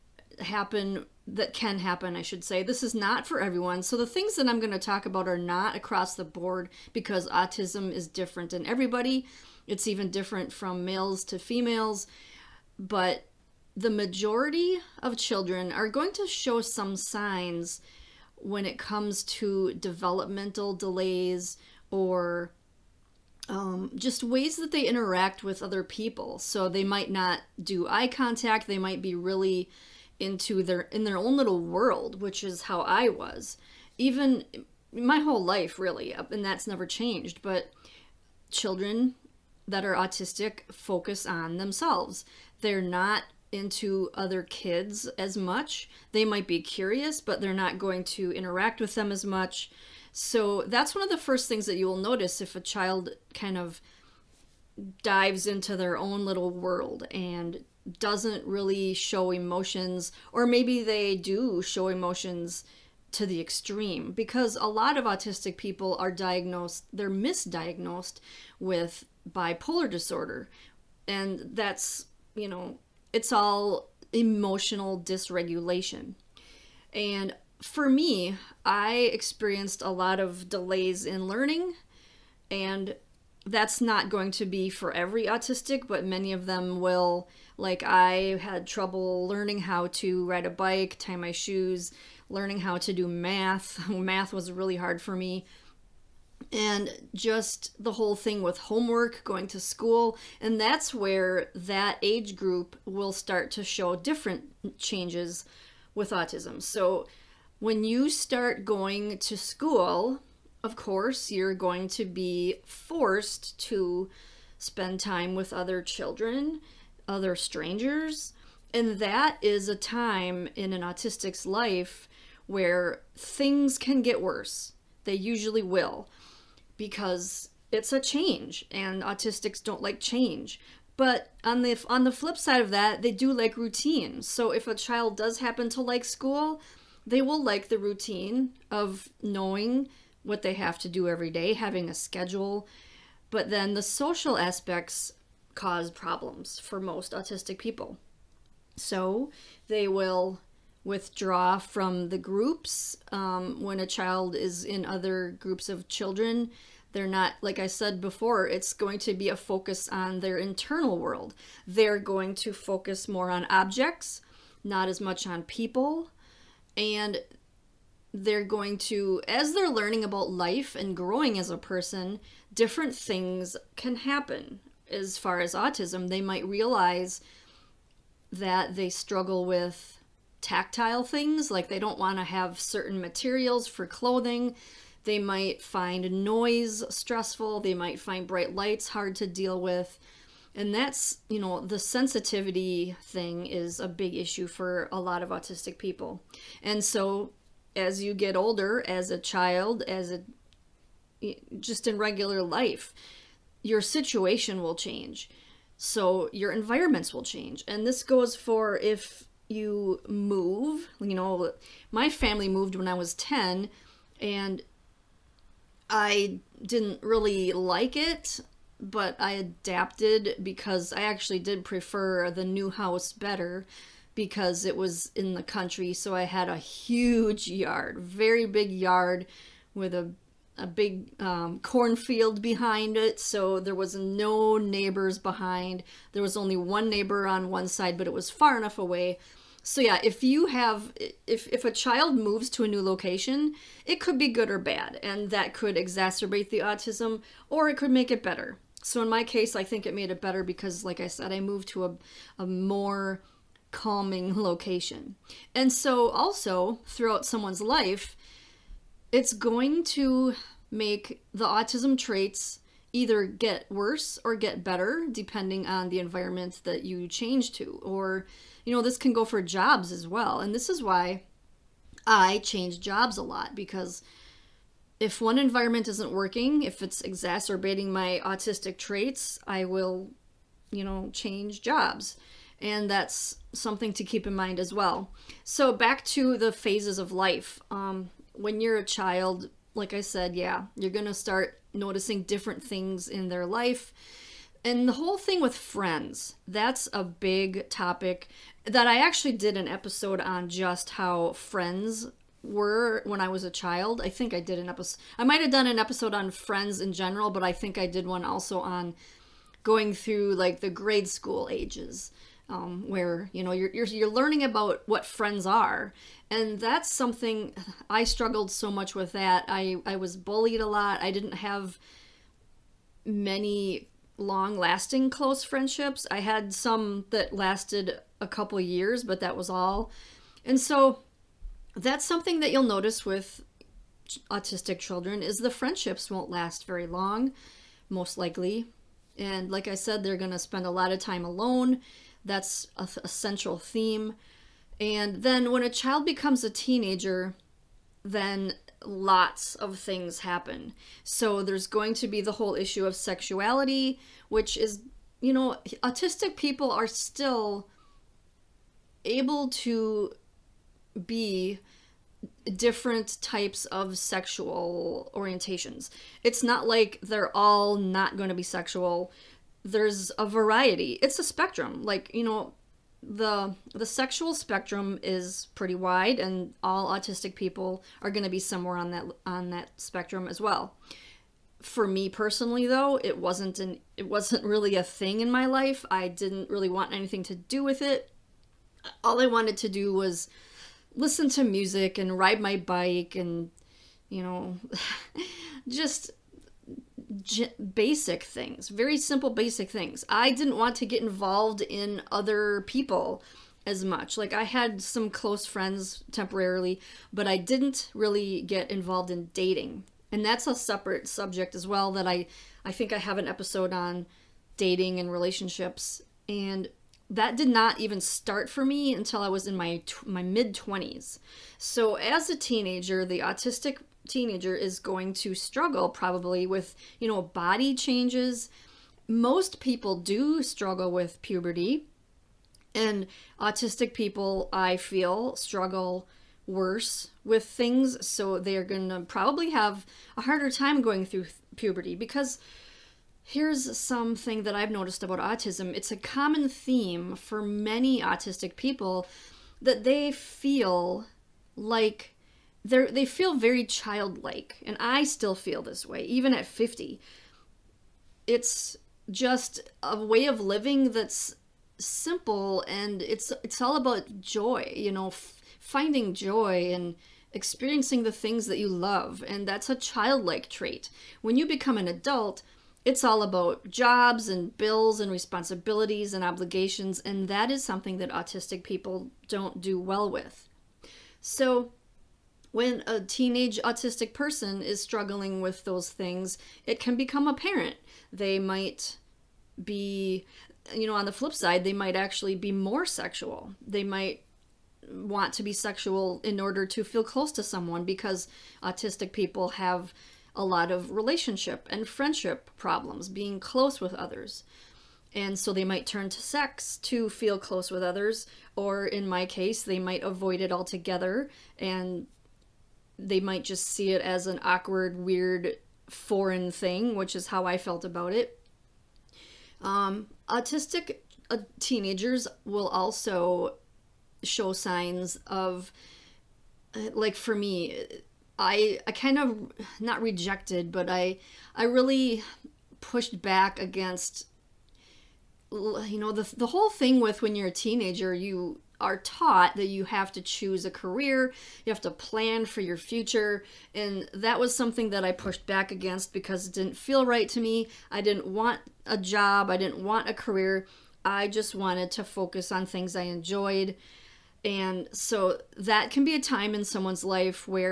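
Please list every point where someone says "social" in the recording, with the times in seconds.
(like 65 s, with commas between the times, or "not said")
143 s.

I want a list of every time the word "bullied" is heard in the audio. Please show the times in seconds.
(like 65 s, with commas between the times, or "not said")
320 s.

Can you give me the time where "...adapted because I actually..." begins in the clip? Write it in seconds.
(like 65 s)
219 s.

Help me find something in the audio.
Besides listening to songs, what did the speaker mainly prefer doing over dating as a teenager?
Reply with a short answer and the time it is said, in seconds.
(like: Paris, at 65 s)
ride my bike, at 392 s.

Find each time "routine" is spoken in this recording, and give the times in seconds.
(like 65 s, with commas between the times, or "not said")
133 s, 137 s.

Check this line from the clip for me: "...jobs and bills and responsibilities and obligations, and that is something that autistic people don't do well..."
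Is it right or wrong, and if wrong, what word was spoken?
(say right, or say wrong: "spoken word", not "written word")
right.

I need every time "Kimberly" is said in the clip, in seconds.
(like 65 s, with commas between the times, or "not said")
not said.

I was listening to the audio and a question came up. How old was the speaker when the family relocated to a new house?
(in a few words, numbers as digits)
10.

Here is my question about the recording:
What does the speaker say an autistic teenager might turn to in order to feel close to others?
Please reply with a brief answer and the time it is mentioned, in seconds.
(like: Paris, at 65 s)
sex, at 506 s.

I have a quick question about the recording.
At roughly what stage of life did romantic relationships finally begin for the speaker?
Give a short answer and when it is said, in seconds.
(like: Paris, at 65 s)
mid 20s, at 420 s.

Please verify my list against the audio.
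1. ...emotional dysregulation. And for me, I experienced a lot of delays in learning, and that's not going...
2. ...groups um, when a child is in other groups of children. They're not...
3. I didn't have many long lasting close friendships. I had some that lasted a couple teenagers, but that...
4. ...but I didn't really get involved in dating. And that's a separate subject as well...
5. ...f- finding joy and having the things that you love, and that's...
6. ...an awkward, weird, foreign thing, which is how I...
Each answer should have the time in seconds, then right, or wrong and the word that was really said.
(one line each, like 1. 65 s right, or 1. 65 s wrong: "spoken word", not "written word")
1. 74 s right
2. 152 s right
3. 321 s wrong: "years", not "teenagers"
4. 407 s right
5. 465 s wrong: "experiencing", not "having"
6. 514 s right.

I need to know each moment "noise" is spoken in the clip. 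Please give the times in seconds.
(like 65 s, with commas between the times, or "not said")
186 s.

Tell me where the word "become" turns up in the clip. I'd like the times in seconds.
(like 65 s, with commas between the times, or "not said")
346 s, 471 s, 486 s.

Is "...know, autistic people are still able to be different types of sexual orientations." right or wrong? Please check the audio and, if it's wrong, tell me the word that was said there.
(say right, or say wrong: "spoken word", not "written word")
right.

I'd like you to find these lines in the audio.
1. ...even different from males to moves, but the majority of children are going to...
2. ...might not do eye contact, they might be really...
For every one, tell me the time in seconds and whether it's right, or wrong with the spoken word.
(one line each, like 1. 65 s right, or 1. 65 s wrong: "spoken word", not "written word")
1. 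9 s wrong: "females", not "moves"
2. 26 s right.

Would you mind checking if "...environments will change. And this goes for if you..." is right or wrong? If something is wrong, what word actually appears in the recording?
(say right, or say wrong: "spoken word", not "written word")
right.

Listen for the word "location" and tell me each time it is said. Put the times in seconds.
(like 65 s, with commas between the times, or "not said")
242 s, 254 s.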